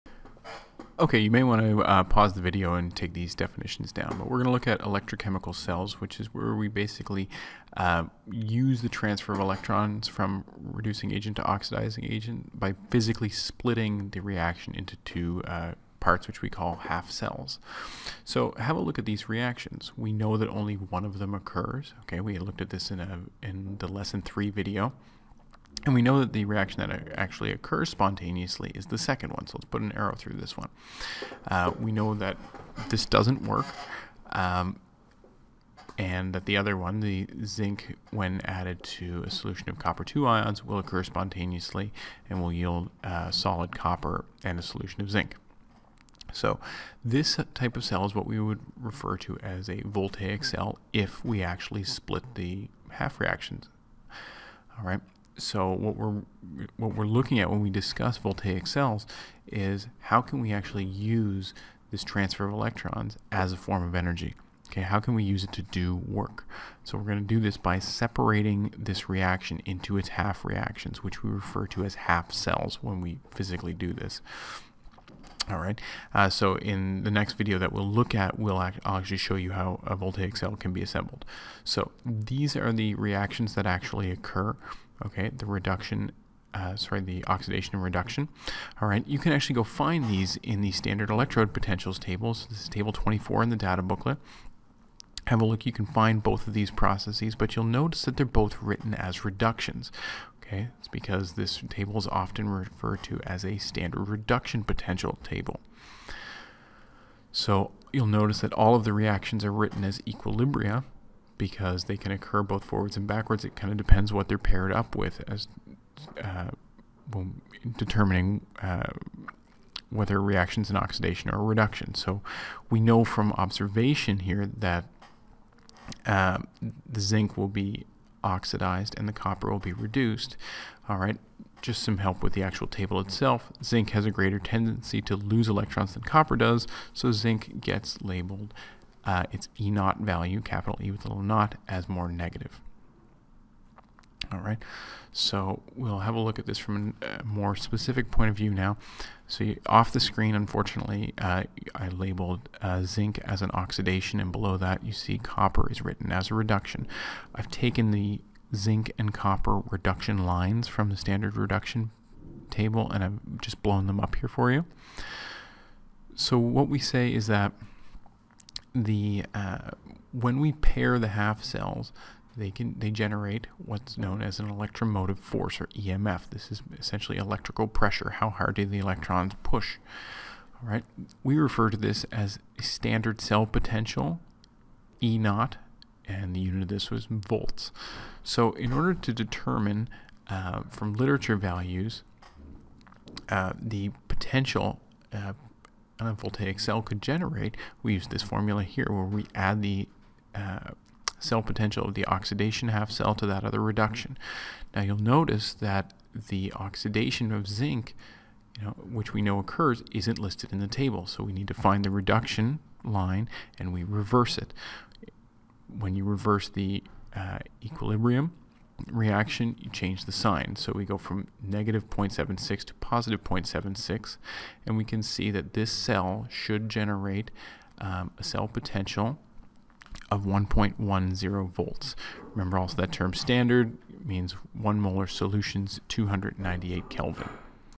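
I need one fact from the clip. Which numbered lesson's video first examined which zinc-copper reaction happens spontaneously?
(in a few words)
Lesson 3.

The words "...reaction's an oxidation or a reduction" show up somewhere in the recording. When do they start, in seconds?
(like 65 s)
120 s.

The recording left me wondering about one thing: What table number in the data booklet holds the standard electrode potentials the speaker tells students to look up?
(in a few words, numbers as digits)
24.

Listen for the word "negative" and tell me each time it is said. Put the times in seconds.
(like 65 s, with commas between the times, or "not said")
142 s, 221 s.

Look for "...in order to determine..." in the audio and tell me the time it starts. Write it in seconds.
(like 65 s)
188 s.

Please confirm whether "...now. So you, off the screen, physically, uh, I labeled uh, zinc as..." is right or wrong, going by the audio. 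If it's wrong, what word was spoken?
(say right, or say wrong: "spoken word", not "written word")
wrong: "unfortunately", not "physically".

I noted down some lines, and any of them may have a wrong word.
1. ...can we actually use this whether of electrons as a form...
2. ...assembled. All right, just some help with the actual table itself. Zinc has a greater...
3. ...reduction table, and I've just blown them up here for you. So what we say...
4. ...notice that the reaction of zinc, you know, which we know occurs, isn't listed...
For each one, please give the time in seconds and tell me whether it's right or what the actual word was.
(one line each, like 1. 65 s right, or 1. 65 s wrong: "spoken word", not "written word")
1. 60 s wrong: "transfer", not "whether"
2. 129 s wrong: "reduced", not "assembled"
3. 161 s right
4. 204 s wrong: "oxidation", not "reaction".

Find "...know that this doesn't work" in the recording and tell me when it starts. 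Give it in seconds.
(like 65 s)
31 s.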